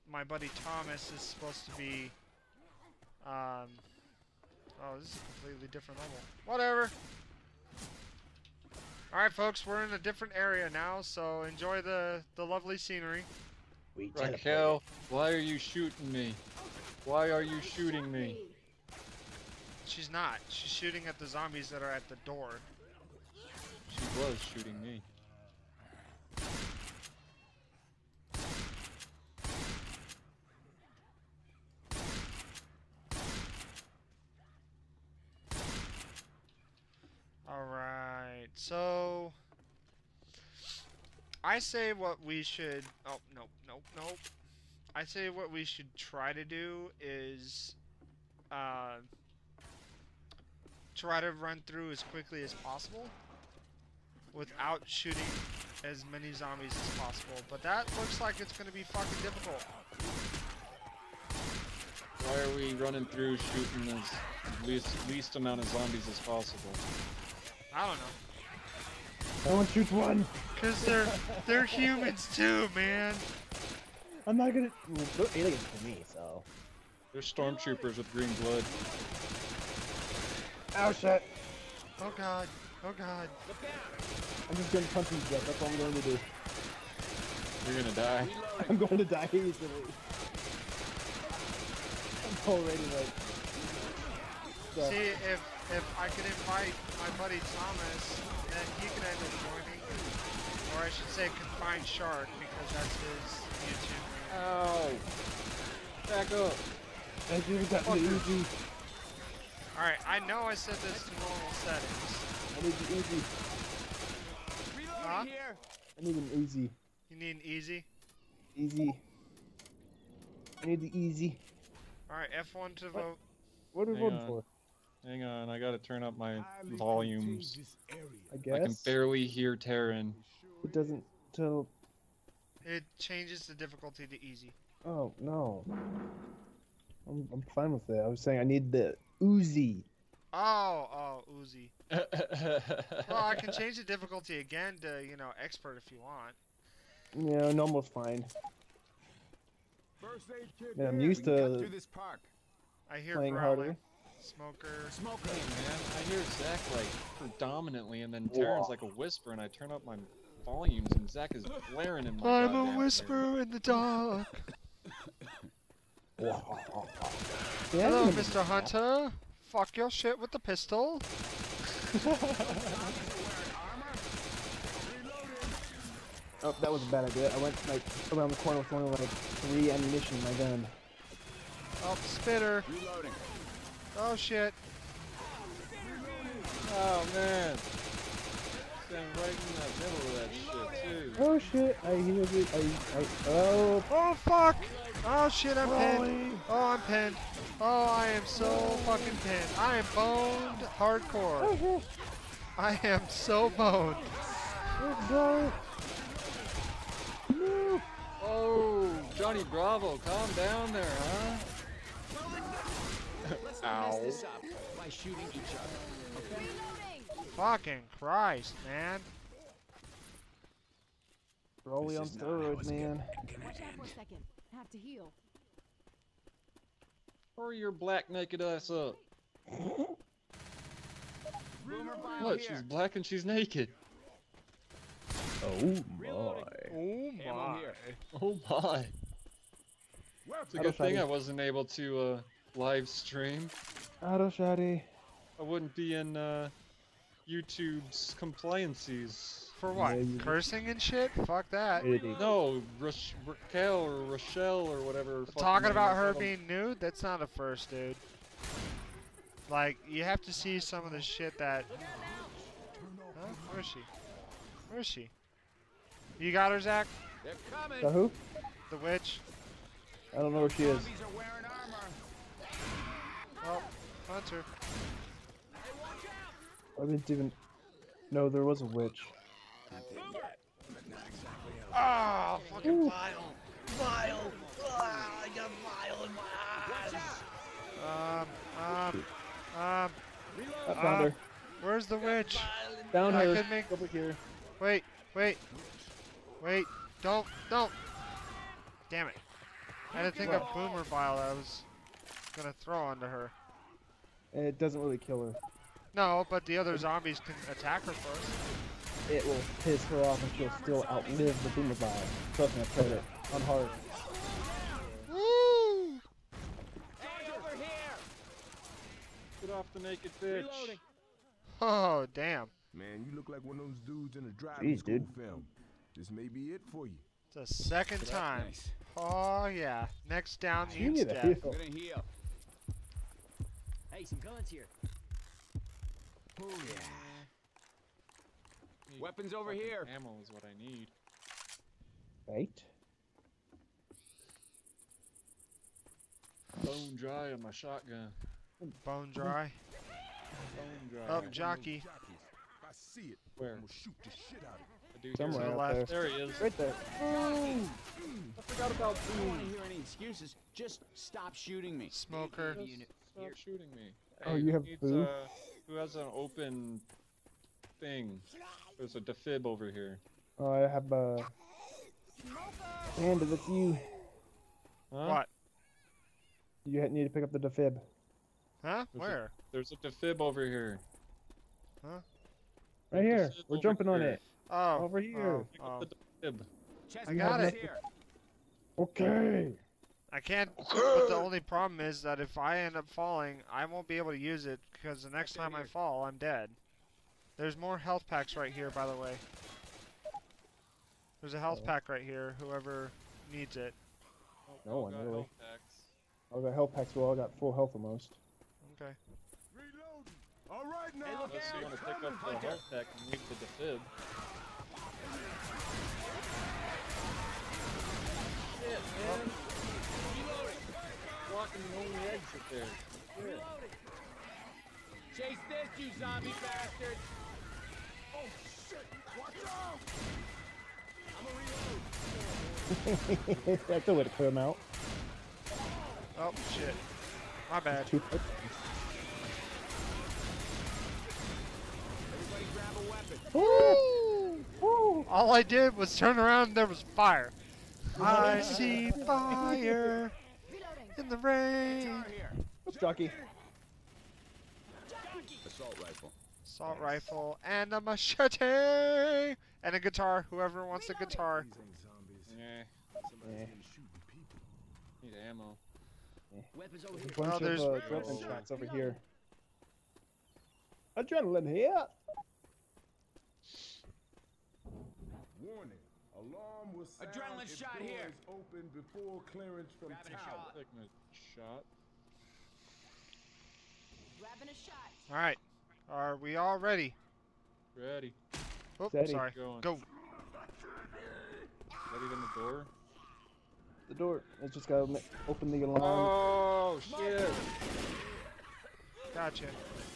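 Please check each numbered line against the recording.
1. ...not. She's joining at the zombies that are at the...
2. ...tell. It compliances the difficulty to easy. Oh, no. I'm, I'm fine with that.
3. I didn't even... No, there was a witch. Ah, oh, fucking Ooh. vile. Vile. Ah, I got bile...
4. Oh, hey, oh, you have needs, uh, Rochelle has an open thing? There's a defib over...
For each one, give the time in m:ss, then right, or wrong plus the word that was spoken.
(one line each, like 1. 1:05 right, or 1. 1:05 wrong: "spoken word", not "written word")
1. 0:20 wrong: "shooting", not "joining"
2. 2:11 wrong: "changes", not "compliances"
3. 4:35 right
4. 6:04 wrong: "Who", not "Rochelle".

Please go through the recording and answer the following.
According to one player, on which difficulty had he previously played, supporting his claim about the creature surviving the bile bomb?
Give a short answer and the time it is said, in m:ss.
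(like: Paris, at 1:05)
hard, at 5:13.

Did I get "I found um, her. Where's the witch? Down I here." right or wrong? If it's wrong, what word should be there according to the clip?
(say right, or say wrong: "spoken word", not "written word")
right.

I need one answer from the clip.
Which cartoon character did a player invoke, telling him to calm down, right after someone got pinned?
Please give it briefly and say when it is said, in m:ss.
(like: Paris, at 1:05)
Johnny Bravo, at 3:29.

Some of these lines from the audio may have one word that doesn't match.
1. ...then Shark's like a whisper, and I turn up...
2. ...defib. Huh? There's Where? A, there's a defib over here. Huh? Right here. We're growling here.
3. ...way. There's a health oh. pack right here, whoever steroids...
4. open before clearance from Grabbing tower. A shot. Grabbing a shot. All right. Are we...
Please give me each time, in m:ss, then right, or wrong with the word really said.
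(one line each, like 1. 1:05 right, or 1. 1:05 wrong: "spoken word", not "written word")
1. 2:38 wrong: "Terran", not "Shark"
2. 6:17 wrong: "jumping", not "growling"
3. 6:38 wrong: "needs", not "steroids"
4. 7:58 right.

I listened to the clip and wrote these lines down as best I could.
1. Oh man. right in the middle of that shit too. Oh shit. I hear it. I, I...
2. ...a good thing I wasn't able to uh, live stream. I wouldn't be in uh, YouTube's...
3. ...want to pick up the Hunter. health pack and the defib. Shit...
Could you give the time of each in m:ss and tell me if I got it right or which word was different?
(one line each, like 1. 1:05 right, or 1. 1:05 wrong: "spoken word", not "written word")
1. 3:06 right
2. 4:00 right
3. 6:51 right.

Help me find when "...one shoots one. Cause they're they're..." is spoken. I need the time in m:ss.
1:09.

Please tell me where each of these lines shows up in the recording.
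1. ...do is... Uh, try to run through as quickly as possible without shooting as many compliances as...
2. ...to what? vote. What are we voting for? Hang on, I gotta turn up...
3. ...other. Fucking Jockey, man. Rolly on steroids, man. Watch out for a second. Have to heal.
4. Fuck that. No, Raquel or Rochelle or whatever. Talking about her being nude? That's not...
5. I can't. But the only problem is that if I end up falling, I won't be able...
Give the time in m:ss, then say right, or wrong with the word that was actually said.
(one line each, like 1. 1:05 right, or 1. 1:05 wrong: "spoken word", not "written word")
1. 0:46 wrong: "zombies", not "compliances"
2. 2:02 right
3. 3:35 wrong: "Christ", not "Jockey"
4. 4:11 right
5. 6:30 right.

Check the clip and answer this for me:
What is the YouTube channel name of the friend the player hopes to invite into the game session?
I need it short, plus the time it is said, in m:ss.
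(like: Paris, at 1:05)
Confined Shark, at 1:41.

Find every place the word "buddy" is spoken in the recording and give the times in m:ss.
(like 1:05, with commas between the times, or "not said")
0:00, 1:37.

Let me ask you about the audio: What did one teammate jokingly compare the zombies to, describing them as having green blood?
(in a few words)
stormtroopers.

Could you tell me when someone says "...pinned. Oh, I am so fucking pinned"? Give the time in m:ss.
3:16.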